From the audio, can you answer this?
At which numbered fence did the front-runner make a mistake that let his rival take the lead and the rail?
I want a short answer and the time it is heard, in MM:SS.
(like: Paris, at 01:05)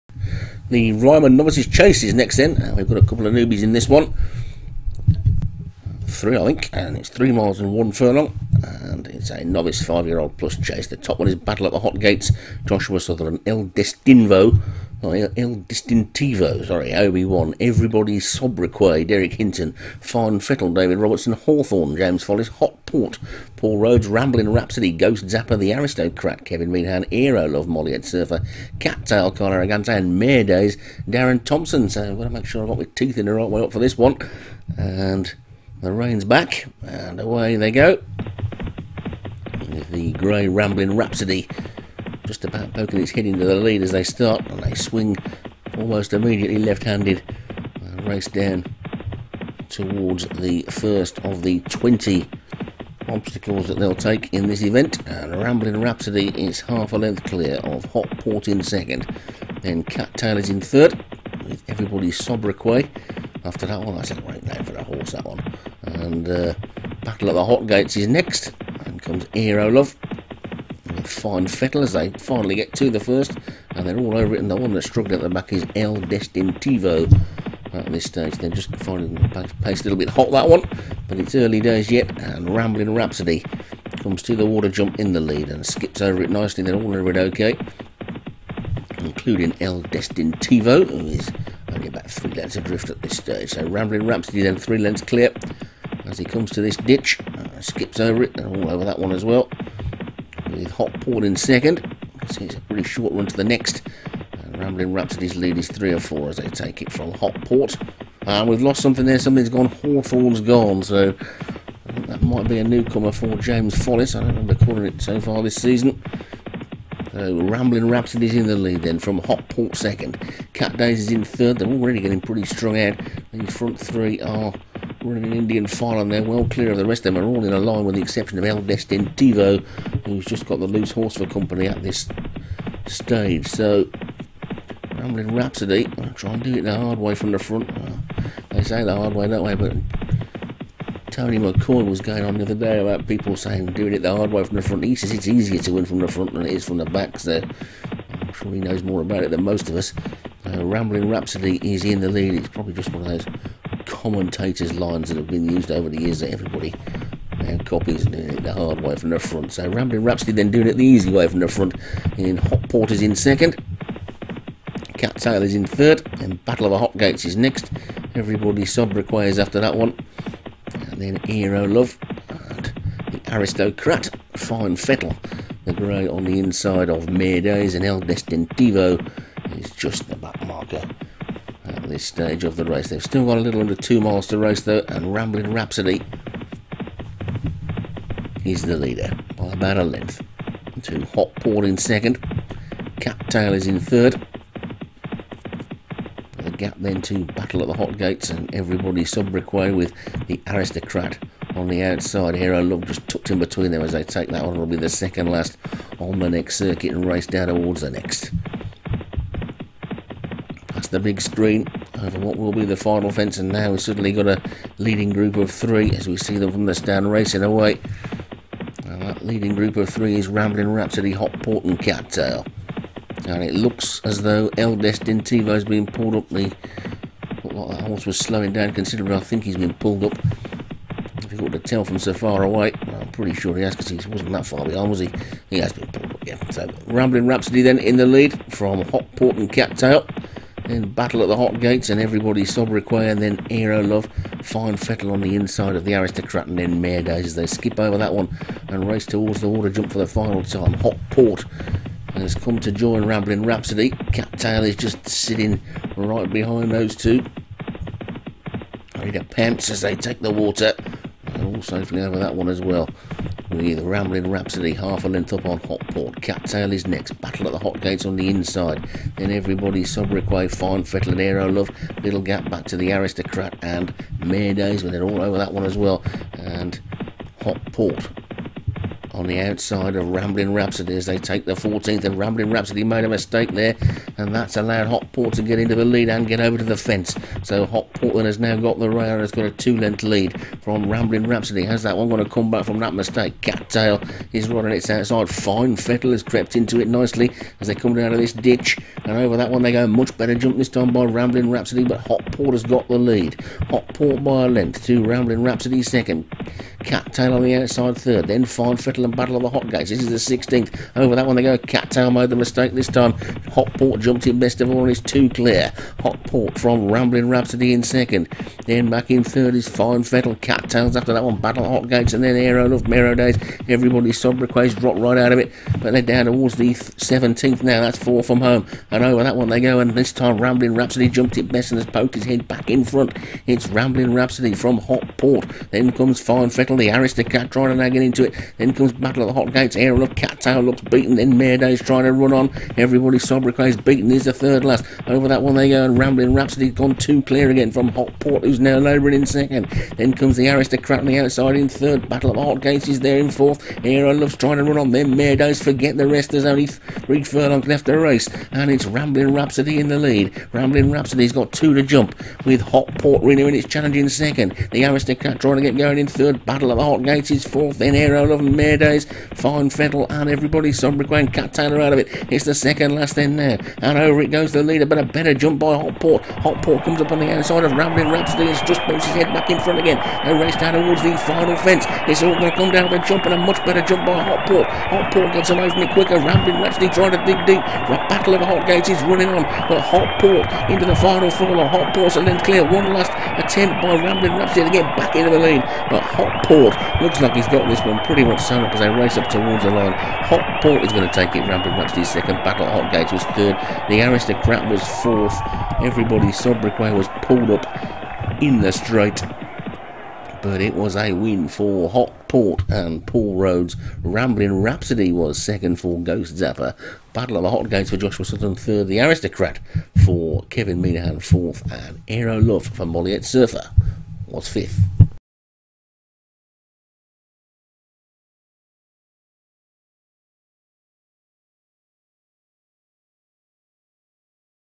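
14th, at 04:41.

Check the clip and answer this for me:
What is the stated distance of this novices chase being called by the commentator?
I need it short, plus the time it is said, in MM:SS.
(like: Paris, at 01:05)
3 miles 1 furlong, at 00:07.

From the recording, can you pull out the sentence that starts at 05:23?
Everybody's sobriquets dropped right out of it.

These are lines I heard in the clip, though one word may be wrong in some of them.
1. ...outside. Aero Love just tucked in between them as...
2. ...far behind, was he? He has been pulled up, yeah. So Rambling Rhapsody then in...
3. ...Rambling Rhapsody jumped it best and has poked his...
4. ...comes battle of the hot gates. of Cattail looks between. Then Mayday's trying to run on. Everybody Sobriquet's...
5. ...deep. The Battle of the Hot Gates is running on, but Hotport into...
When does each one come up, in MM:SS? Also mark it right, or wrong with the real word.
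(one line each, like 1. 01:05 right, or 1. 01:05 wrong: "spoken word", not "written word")
1. 03:21 right
2. 03:54 right
3. 05:30 right
4. 05:38 wrong: "beaten", not "between"
5. 06:27 right.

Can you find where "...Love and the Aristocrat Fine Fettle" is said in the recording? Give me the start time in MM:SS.
02:51.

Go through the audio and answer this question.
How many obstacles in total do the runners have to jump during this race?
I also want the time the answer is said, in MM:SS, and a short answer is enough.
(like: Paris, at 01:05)
20, at 00:51.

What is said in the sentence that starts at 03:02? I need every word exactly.
They've still got a little under two miles to race though, and Rambling Rhapsody is the leader by about a length.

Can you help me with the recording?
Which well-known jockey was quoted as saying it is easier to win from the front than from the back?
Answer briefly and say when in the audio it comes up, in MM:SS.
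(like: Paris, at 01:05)
Tony McCoy, at 02:21.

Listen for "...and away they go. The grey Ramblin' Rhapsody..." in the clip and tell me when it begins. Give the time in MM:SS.
00:36.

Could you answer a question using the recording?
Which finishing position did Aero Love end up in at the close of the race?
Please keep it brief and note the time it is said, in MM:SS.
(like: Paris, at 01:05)
Fifth, at 07:04.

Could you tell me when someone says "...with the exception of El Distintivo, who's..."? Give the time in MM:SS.
02:07.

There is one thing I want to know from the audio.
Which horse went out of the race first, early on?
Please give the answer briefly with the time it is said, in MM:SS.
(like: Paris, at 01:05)
Hawthorne, at 01:49.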